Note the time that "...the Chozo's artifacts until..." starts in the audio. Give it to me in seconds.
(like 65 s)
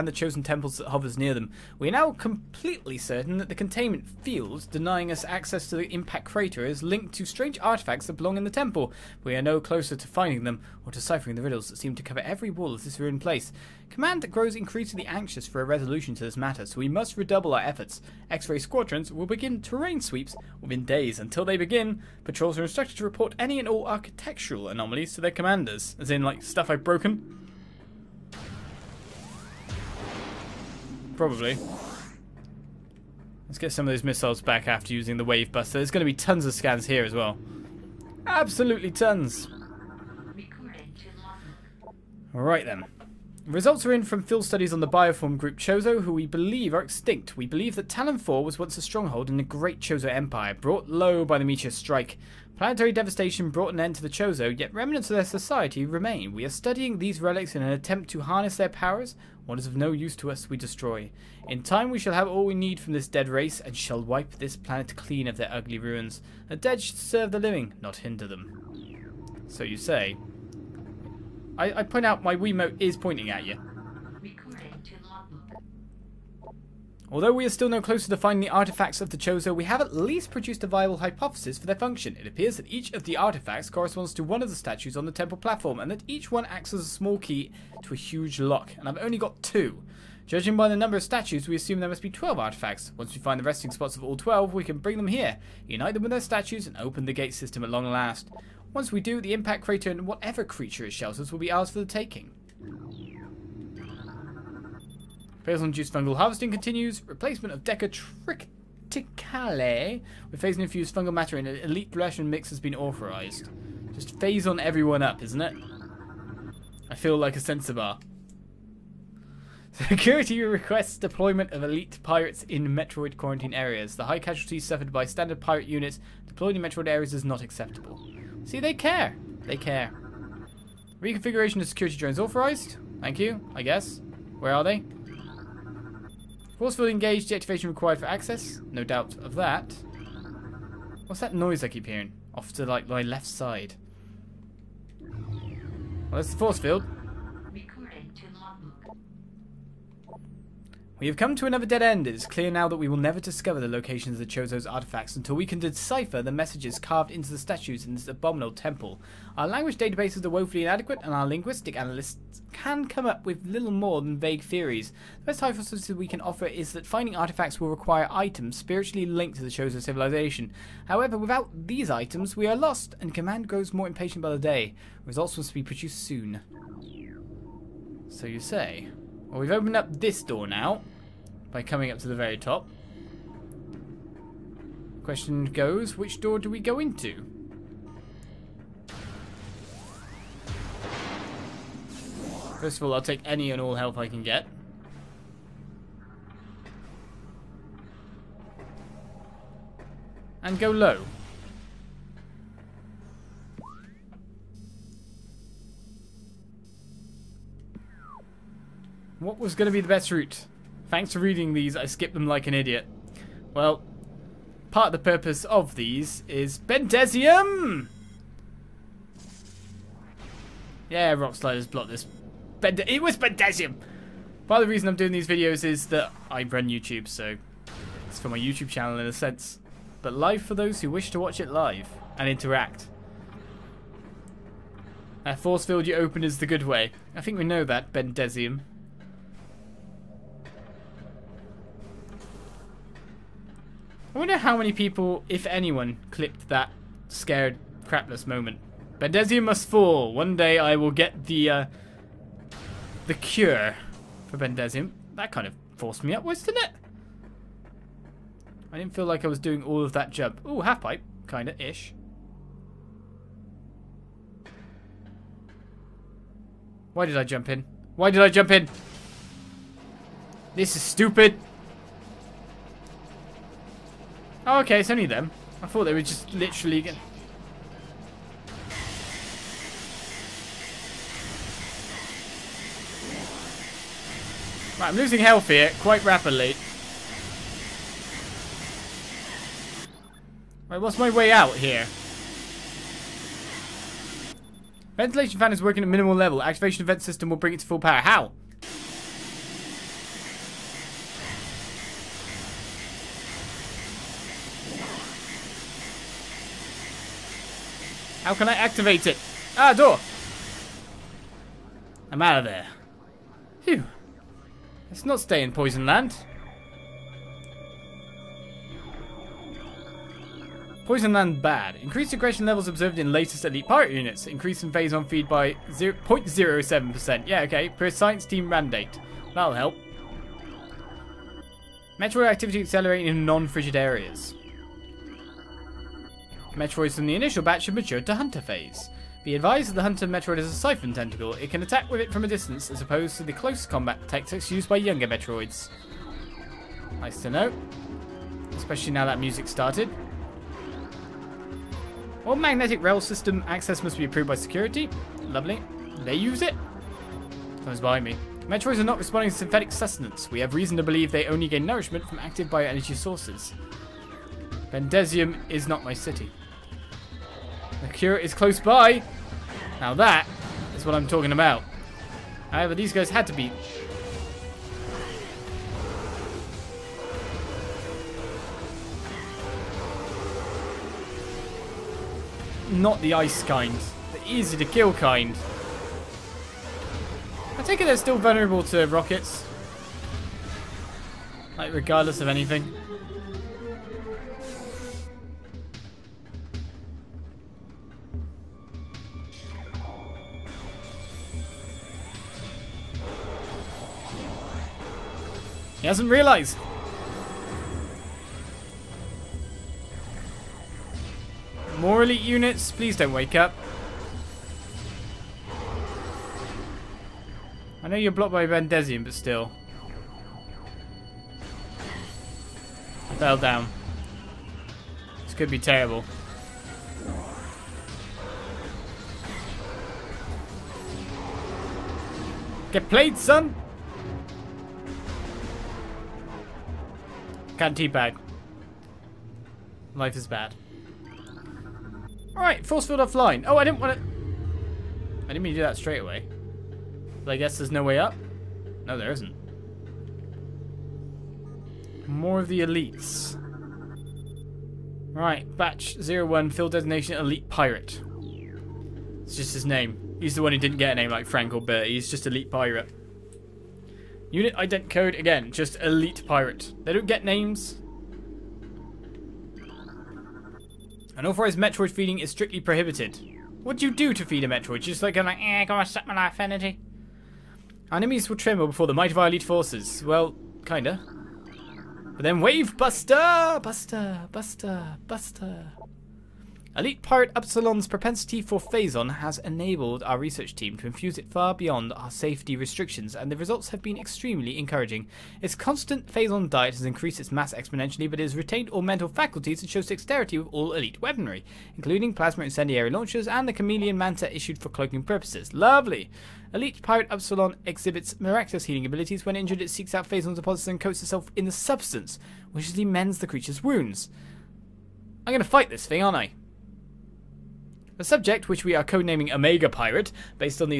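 154 s.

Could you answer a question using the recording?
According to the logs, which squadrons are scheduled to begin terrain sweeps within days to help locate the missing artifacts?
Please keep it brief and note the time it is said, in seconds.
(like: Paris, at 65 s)
X-ray squadrons, at 18 s.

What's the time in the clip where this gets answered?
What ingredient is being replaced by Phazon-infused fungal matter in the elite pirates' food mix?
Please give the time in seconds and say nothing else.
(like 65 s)
107 s.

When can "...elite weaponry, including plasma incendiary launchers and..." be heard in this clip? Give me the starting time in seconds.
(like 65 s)
500 s.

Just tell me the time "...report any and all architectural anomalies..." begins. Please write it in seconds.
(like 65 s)
23 s.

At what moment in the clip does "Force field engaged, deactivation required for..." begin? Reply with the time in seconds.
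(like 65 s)
136 s.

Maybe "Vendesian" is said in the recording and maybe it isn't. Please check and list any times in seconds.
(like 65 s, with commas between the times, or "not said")
418 s.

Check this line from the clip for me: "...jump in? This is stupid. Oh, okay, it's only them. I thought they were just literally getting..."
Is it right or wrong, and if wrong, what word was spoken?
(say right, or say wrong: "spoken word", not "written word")
right.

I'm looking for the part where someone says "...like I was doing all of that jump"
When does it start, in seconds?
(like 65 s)
259 s.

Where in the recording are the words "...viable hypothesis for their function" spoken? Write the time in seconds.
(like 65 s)
80 s.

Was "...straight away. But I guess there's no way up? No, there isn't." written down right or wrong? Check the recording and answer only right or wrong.
right.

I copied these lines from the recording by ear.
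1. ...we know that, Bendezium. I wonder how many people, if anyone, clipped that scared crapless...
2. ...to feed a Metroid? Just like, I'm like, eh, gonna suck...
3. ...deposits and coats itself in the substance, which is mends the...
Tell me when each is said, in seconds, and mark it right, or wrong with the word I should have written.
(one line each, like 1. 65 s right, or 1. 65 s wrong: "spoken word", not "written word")
1. 237 s right
2. 474 s right
3. 510 s right.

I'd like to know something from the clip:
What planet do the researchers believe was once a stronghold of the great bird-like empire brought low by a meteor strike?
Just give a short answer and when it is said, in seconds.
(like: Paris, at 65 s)
Tallon 4, at 47 s.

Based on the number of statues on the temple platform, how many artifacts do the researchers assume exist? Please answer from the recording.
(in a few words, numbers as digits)
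12.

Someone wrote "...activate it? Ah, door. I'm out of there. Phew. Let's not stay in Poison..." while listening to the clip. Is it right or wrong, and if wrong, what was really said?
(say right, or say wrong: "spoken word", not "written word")
right.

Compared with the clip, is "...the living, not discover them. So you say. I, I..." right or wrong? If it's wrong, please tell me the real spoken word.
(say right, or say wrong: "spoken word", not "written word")
wrong: "hinder", not "discover".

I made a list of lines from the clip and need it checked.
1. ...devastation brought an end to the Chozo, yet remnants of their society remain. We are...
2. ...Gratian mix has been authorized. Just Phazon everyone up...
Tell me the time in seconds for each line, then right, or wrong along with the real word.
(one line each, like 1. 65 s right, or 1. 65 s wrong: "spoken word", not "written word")
1. 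52 s right
2. 111 s right.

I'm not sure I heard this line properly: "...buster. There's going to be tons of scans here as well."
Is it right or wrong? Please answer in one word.
right.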